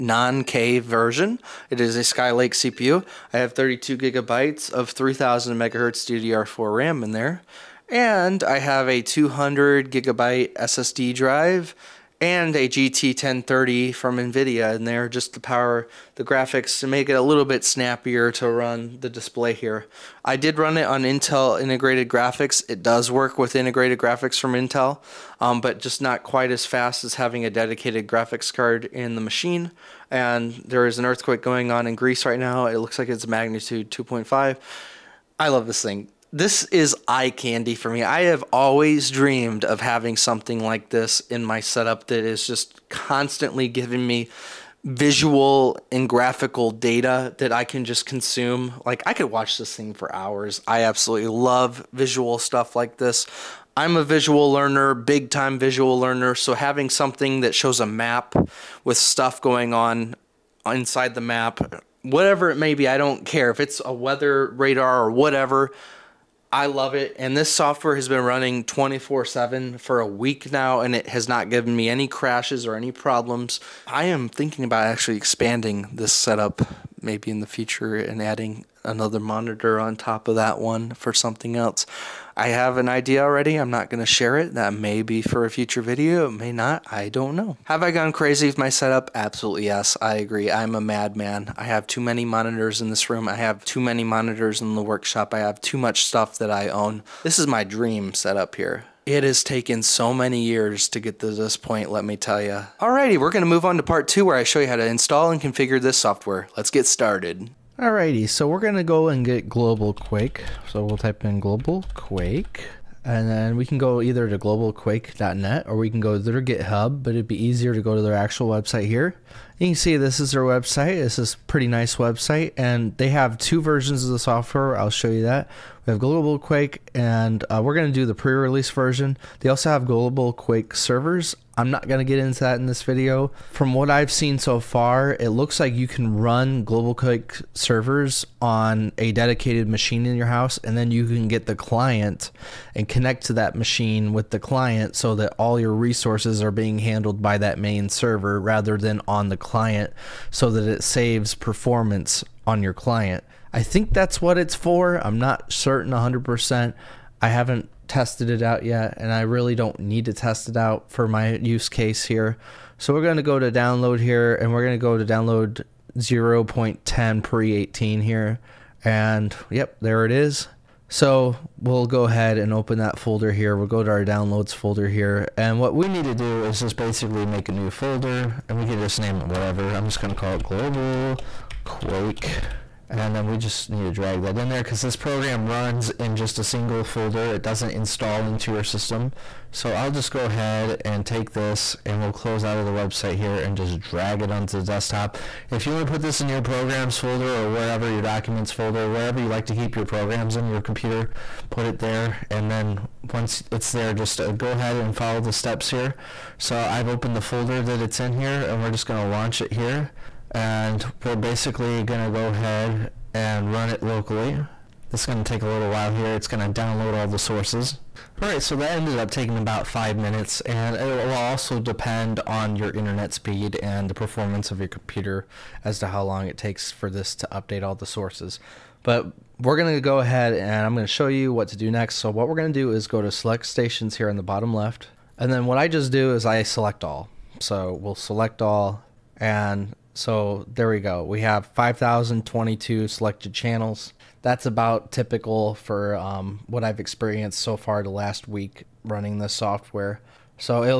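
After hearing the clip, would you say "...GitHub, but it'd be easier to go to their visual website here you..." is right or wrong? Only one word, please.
wrong.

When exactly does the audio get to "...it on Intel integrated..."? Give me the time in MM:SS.
00:20.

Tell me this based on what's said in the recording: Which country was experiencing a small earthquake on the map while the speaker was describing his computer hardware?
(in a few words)
Greece.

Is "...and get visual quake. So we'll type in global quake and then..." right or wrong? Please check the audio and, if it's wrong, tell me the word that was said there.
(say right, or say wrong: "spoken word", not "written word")
wrong: "global", not "visual".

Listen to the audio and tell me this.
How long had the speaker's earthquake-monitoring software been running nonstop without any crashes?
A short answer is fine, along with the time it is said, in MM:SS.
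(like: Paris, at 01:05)
A week, at 01:09.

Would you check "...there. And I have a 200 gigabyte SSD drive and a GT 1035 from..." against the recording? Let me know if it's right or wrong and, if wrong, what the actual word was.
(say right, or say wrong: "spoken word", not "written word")
wrong: "1030", not "1035".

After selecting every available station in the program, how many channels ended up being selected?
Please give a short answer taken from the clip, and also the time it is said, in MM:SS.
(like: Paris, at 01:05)
5,022, at 04:01.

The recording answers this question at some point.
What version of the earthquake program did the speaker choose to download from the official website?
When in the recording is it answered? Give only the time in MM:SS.
02:45.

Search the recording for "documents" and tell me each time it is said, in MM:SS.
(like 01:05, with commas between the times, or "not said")
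03:18.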